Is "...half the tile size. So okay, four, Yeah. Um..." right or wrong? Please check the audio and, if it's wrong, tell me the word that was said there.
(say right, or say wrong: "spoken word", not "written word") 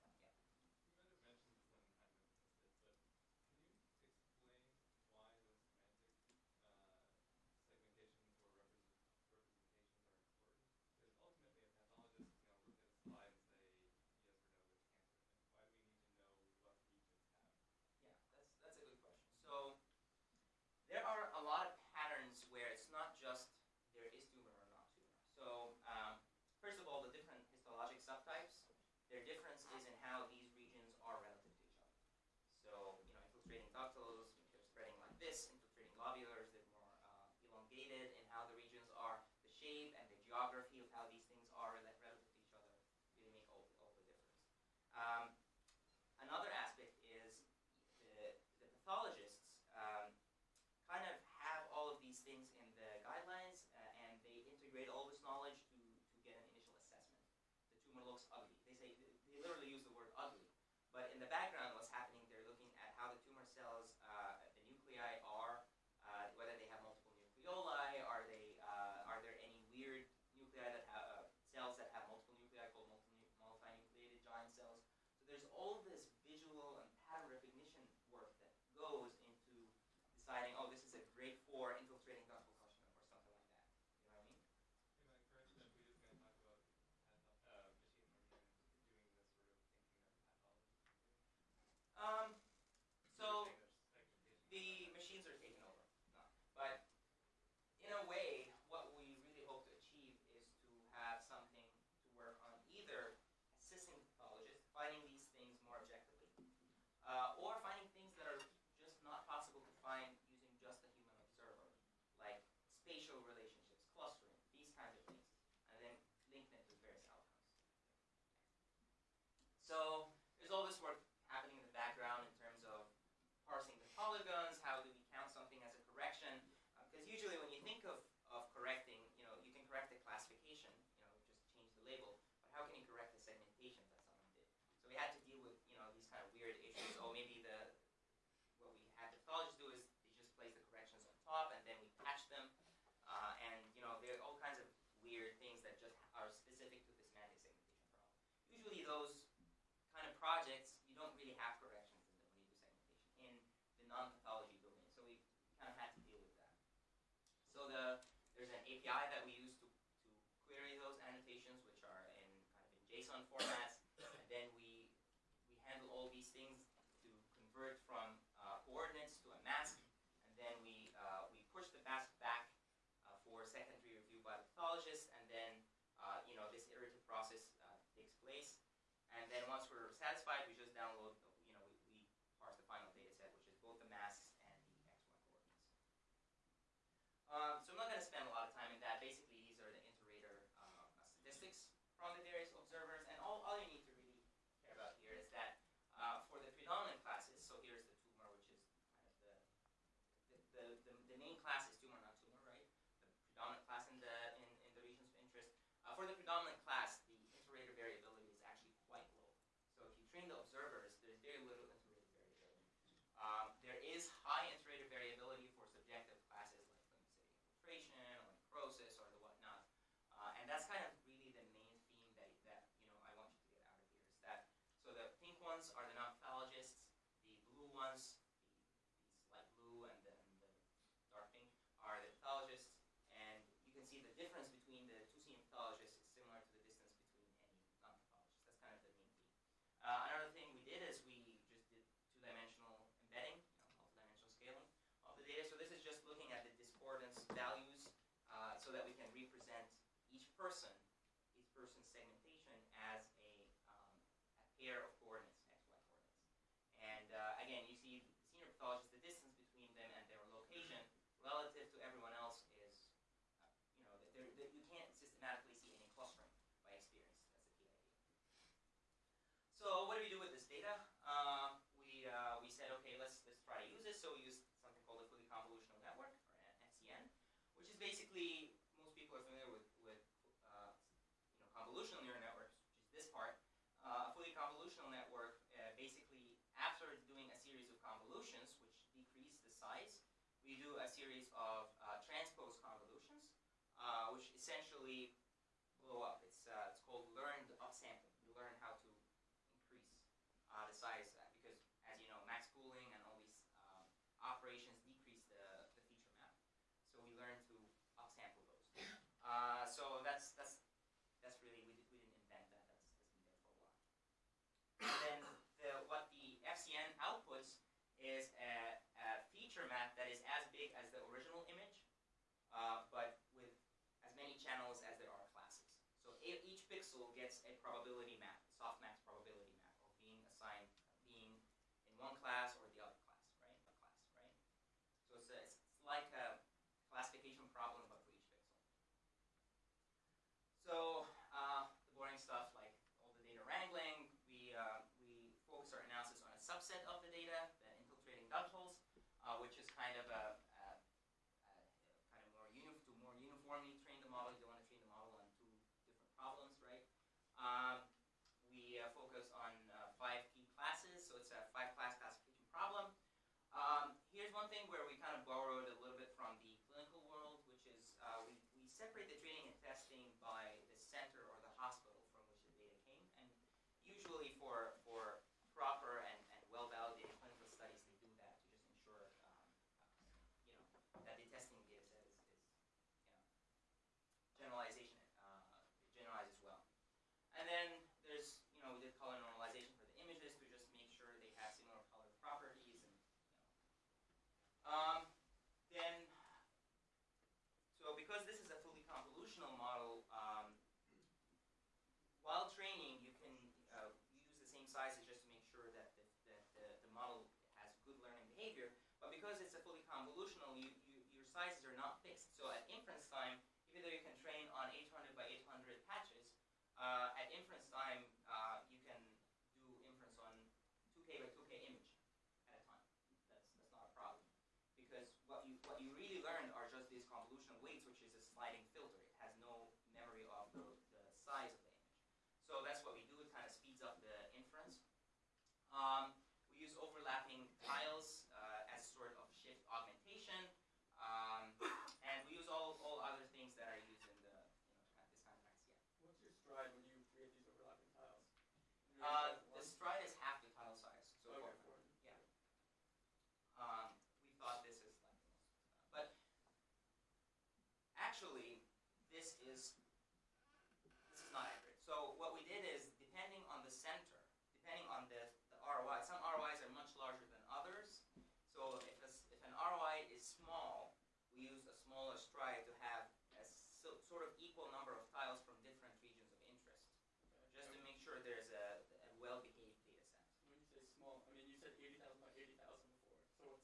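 right.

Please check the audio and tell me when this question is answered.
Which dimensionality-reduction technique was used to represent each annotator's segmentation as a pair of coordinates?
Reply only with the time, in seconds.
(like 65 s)
243 s.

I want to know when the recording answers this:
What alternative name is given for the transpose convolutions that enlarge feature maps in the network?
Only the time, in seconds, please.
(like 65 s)
297 s.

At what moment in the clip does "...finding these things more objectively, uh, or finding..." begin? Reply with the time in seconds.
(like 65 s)
104 s.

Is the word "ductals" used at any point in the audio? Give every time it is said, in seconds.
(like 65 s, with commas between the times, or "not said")
33 s, 348 s.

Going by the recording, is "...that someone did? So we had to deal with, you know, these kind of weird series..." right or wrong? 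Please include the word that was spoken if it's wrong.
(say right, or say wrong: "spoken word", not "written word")
wrong: "issues", not "series".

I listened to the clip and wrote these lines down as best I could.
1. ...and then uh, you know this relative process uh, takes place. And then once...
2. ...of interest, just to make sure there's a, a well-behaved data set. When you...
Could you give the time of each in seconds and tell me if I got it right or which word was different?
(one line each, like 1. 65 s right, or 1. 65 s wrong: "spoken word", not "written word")
1. 175 s wrong: "iterative", not "relative"
2. 476 s right.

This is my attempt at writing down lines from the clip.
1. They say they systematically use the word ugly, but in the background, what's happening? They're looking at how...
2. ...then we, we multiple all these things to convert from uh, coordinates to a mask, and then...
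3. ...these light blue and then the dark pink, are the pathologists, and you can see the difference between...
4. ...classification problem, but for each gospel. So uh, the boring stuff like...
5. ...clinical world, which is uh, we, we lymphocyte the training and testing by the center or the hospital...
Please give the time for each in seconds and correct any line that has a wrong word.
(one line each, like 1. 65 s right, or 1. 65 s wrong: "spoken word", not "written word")
1. 58 s wrong: "literally", not "systematically"
2. 164 s wrong: "handle", not "multiple"
3. 229 s right
4. 336 s wrong: "pixel", not "gospel"
5. 366 s wrong: "separate", not "lymphocyte".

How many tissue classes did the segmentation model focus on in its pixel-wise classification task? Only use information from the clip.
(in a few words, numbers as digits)
5.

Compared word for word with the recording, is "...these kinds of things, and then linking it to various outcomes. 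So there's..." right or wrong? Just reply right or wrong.
right.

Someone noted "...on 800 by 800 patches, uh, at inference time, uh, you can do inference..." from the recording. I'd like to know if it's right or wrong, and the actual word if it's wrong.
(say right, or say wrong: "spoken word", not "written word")
right.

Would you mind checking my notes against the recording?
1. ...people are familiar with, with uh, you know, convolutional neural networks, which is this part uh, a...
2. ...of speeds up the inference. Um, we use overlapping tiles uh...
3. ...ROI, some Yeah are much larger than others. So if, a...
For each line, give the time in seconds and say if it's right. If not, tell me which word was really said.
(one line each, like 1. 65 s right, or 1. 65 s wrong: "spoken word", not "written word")
1. 278 s right
2. 433 s right
3. 465 s wrong: "ROIs", not "Yeah".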